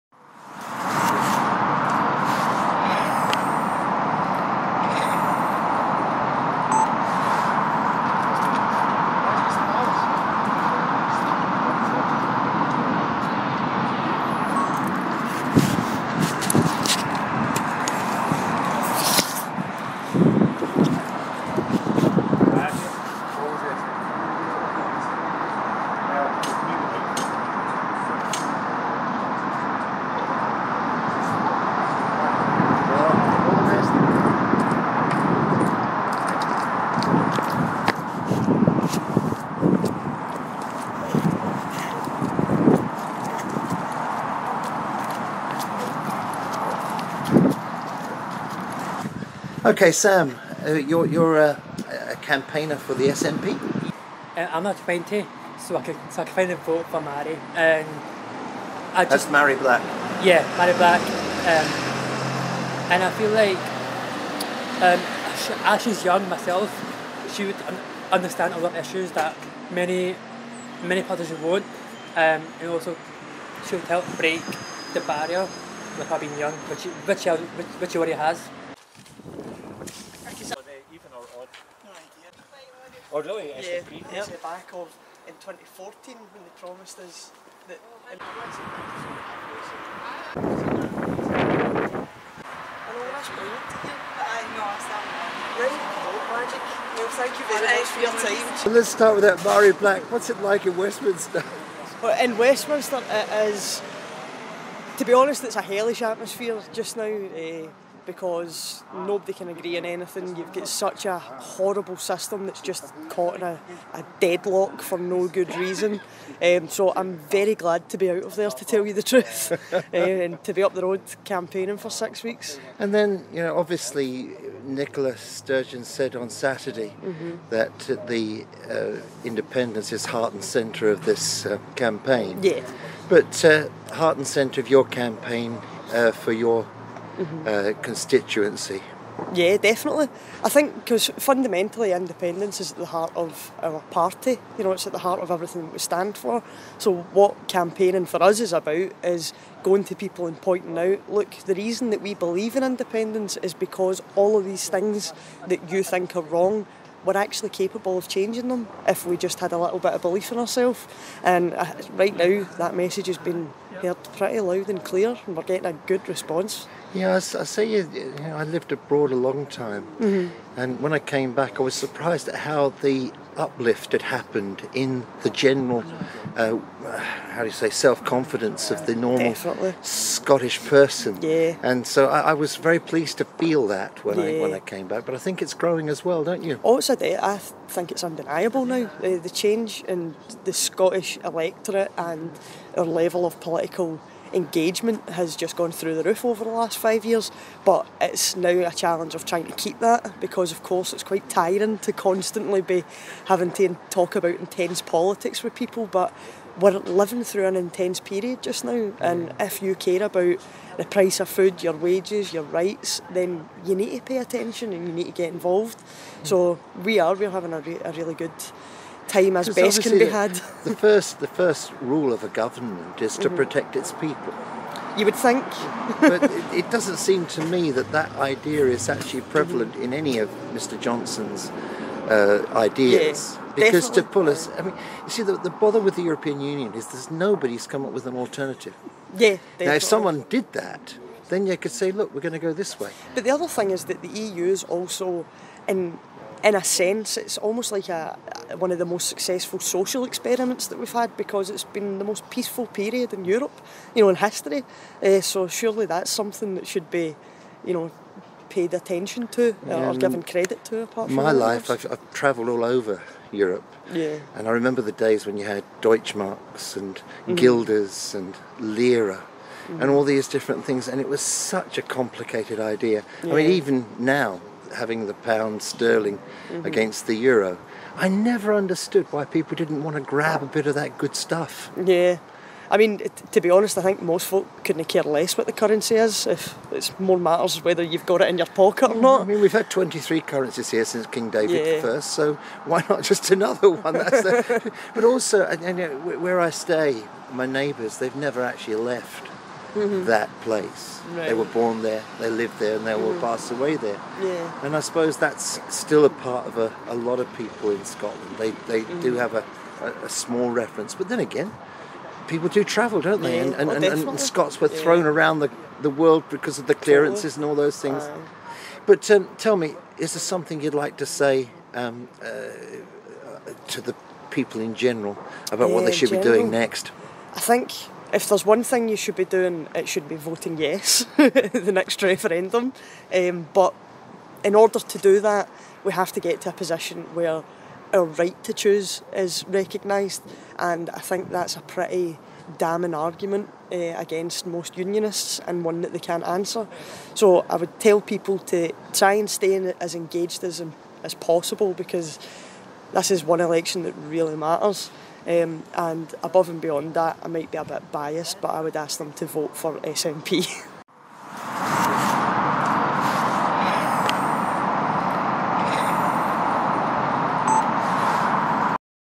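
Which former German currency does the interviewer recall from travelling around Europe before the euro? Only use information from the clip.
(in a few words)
Deutschmarks.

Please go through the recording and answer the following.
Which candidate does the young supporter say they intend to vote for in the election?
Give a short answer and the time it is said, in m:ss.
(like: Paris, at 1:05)
Mhairi Black, at 1:00.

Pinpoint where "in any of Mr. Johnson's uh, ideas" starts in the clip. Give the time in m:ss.
3:49.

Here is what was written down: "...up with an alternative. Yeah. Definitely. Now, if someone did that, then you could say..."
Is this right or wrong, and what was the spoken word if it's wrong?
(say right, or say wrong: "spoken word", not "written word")
right.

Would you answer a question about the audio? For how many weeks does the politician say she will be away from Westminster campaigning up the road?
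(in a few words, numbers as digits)
6.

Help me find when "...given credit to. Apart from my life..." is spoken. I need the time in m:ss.
4:19.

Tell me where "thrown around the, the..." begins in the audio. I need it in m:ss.
5:14.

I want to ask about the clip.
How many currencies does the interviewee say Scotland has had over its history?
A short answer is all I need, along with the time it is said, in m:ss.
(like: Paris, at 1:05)
23, at 4:49.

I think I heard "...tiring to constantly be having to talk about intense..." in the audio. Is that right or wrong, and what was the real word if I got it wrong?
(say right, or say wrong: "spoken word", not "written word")
right.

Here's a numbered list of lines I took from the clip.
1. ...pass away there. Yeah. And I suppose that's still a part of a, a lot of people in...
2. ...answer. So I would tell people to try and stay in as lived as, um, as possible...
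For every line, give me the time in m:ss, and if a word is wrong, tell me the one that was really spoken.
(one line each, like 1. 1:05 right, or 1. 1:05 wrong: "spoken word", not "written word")
1. 5:03 right
2. 5:46 wrong: "engaged", not "lived".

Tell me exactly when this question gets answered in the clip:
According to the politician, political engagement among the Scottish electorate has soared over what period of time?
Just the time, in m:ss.
3:16.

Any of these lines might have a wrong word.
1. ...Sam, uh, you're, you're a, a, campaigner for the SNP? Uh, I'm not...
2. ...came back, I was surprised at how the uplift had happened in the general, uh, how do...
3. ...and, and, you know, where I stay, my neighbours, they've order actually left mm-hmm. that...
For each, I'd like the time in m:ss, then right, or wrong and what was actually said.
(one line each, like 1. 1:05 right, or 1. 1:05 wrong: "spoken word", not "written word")
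1. 0:49 right
2. 2:50 right
3. 4:55 wrong: "never", not "order".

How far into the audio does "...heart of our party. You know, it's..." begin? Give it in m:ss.
2:22.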